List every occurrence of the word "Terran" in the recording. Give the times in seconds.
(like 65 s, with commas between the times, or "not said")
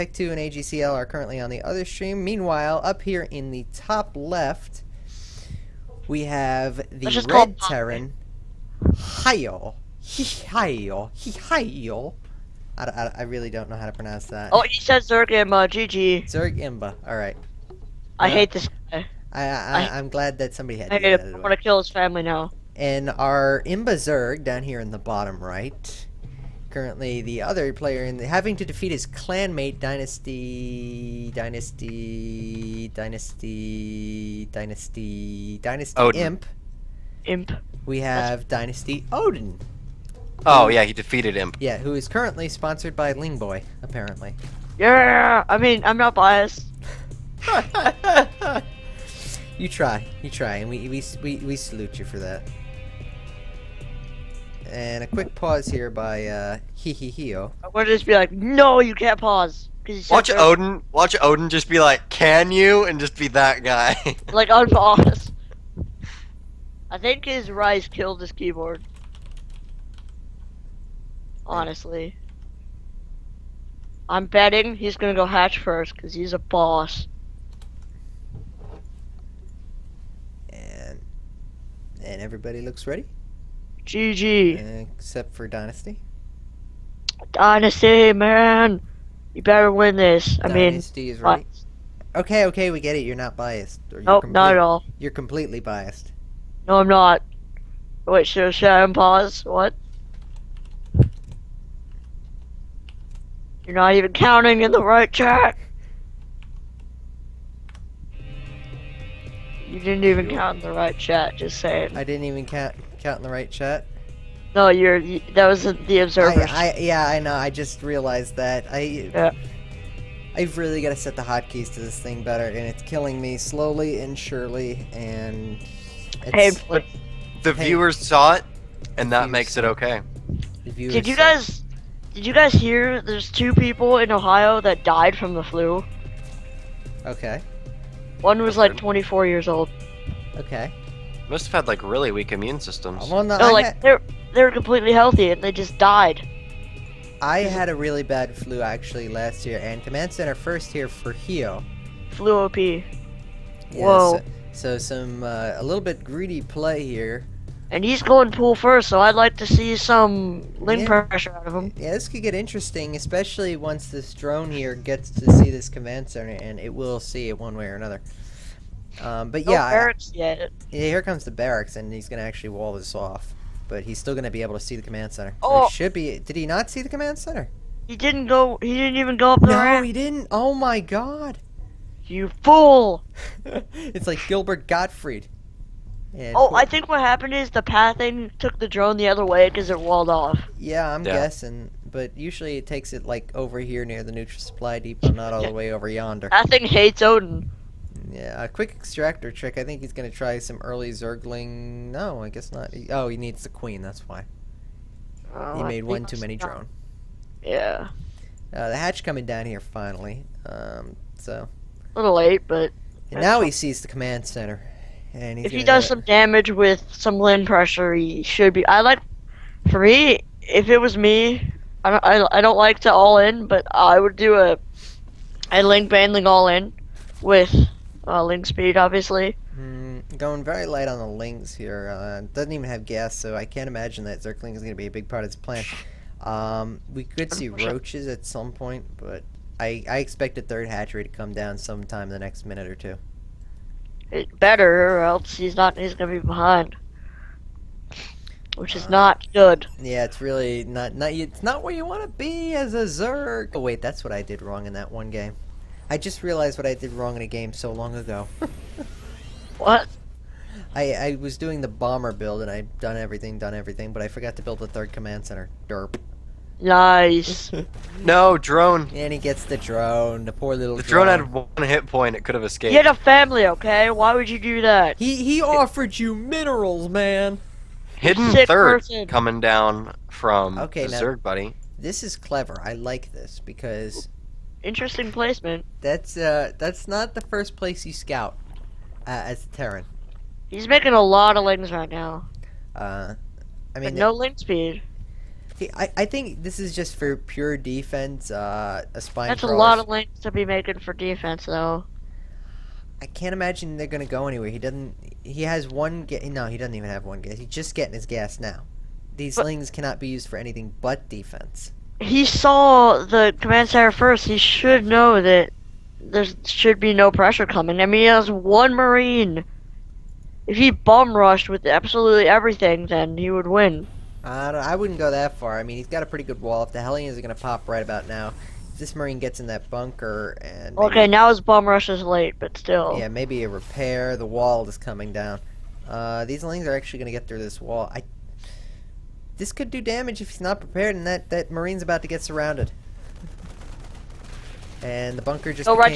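7 s, 289 s.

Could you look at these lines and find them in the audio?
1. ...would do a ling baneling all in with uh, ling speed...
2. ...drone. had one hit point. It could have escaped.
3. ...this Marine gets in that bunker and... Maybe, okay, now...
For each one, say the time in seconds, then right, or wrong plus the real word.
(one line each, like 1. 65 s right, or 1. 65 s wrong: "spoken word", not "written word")
1. 223 s right
2. 270 s right
3. 328 s right.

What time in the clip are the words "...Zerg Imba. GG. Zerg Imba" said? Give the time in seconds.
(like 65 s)
15 s.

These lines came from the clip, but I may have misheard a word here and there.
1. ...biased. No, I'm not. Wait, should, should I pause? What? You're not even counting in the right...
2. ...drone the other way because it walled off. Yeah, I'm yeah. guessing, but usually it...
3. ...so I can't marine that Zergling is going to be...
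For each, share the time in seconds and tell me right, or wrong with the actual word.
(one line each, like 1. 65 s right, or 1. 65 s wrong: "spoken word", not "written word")
1. 95 s right
2. 188 s right
3. 233 s wrong: "imagine", not "marine".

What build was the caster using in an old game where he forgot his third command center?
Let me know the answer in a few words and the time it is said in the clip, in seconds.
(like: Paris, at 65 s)
the bomber build, at 261 s.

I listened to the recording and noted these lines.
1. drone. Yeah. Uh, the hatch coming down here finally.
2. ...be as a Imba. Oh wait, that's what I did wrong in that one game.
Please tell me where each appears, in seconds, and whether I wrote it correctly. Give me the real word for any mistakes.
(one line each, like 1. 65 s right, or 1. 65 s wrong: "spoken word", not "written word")
1. 206 s right
2. 252 s wrong: "Zerg", not "Imba".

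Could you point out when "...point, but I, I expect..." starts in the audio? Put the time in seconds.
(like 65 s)
238 s.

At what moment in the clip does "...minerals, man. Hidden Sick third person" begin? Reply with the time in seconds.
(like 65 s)
276 s.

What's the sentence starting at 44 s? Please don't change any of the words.
Yeah, I mean, I'm not biased.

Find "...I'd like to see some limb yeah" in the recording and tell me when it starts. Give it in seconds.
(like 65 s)
158 s.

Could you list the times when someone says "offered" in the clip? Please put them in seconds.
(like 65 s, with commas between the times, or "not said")
275 s.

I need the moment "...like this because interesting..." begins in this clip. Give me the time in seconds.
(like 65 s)
282 s.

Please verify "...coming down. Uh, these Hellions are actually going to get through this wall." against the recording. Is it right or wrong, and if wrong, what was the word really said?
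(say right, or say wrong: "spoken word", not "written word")
right.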